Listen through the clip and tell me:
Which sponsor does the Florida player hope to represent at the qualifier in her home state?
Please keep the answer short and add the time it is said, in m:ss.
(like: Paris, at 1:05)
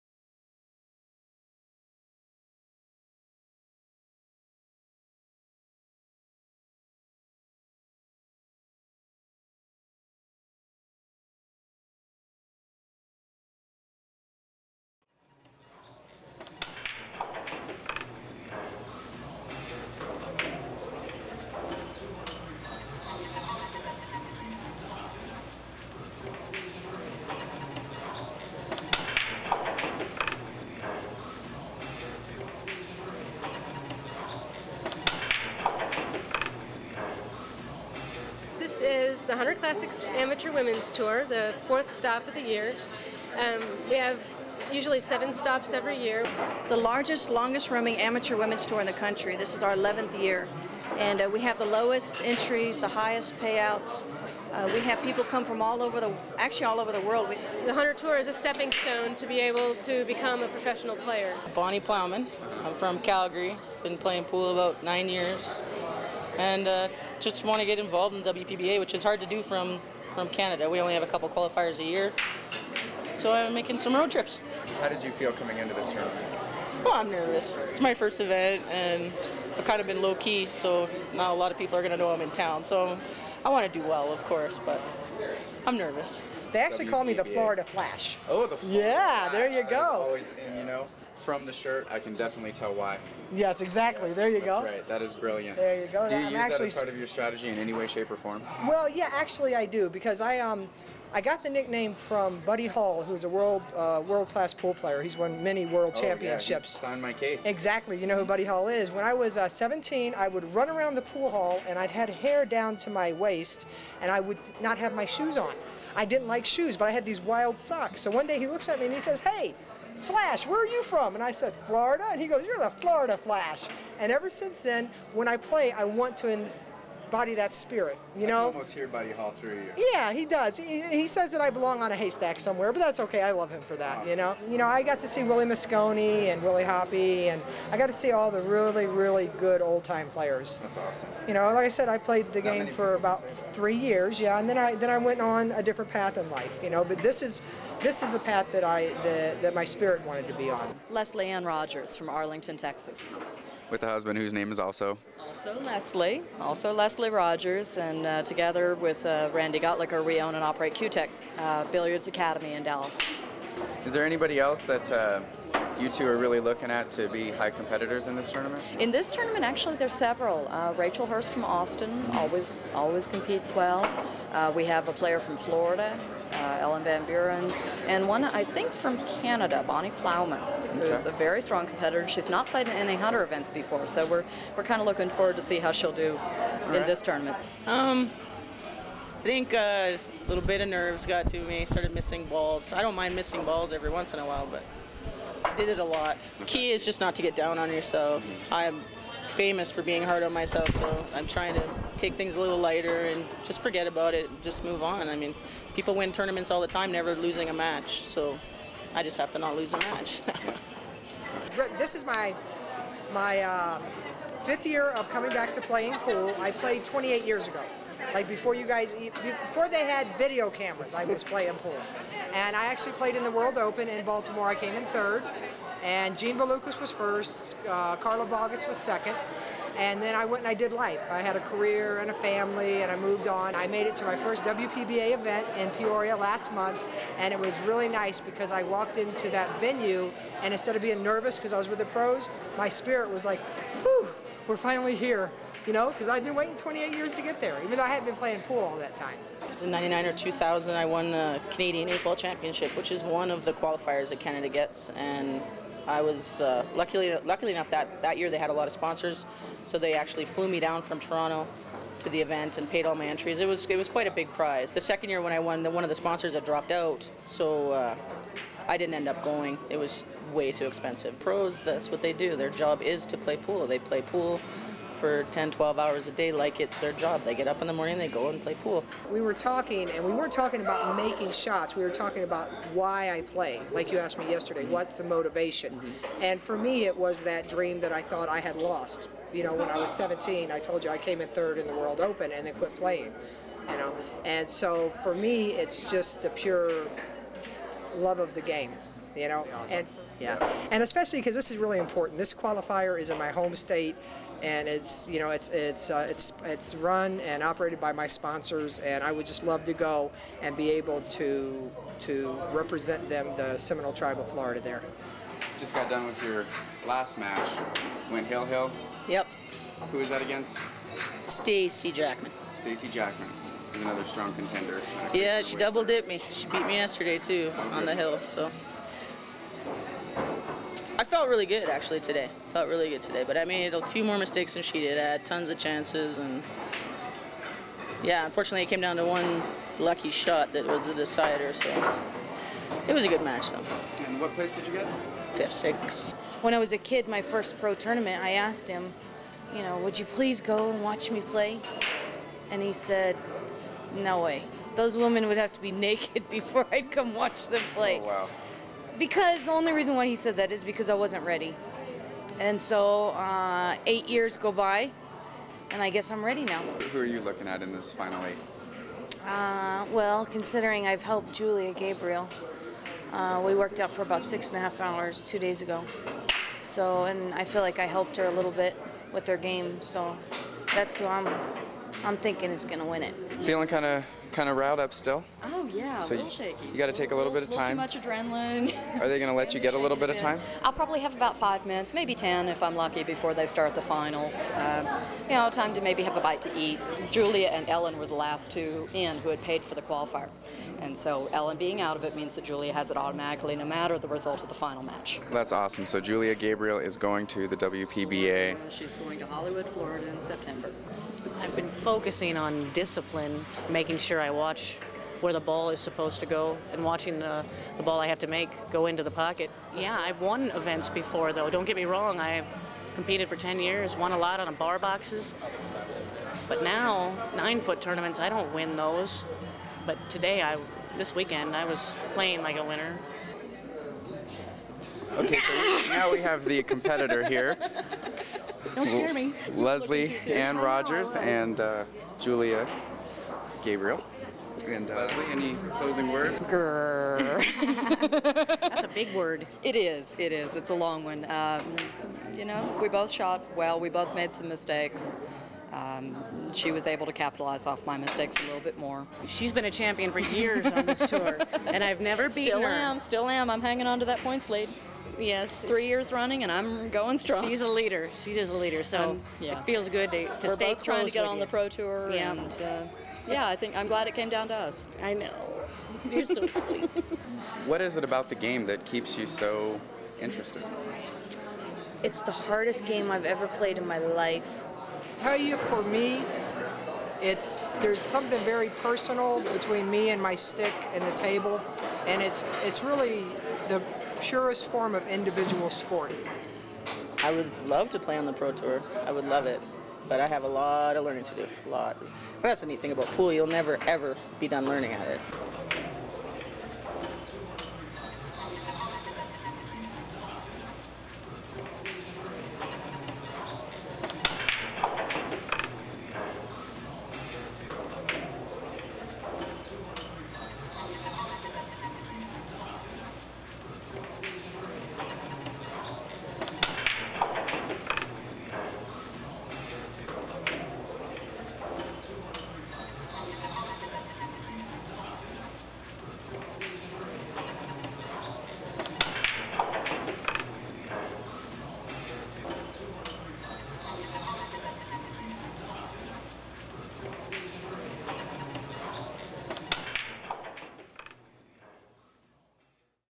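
Seminole Tribe of Florida, at 5:13.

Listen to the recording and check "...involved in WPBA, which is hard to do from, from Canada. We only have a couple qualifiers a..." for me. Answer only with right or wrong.
right.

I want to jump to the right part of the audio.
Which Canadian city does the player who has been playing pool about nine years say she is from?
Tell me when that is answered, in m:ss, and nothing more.
1:02.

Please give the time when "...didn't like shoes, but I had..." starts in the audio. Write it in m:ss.
1:56.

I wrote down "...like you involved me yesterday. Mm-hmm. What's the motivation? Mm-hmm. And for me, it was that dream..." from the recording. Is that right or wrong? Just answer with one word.
wrong.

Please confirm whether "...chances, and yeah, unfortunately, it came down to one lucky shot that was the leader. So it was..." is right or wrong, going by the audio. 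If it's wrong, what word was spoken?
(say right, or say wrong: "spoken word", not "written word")
wrong: "decider", not "leader".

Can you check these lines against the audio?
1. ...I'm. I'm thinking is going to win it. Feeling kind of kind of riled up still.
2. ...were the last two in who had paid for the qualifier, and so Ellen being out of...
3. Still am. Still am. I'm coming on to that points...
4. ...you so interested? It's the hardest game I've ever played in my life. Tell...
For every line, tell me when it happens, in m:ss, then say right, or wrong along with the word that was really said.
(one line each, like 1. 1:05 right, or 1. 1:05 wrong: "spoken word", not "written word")
1. 6:21 right
2. 6:37 right
3. 7:42 wrong: "hanging", not "coming"
4. 7:59 right.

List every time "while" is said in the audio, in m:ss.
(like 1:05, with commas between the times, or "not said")
3:14.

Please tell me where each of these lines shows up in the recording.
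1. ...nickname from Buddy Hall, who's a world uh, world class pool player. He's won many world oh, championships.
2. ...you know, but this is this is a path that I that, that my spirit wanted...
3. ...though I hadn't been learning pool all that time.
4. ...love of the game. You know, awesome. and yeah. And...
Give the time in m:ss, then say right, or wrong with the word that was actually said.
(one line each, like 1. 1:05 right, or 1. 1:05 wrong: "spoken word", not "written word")
1. 1:41 right
2. 2:26 right
3. 4:07 wrong: "playing", not "learning"
4. 4:57 right.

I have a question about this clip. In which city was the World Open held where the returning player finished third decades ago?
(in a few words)
Baltimore.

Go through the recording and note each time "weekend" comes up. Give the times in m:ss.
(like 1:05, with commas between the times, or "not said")
7:11.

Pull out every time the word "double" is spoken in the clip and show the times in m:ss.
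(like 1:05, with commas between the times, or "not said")
5:25.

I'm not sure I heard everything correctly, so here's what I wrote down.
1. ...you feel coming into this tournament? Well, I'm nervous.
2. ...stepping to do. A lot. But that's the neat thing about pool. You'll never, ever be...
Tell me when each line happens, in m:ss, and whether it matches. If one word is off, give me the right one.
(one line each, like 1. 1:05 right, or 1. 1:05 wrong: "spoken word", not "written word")
1. 1:15 right
2. 8:21 wrong: "learning", not "stepping".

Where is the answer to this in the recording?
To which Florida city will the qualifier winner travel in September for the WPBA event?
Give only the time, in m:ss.
6:49.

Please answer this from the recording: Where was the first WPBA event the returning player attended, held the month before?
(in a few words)
Peoria.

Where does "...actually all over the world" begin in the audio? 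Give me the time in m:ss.
0:56.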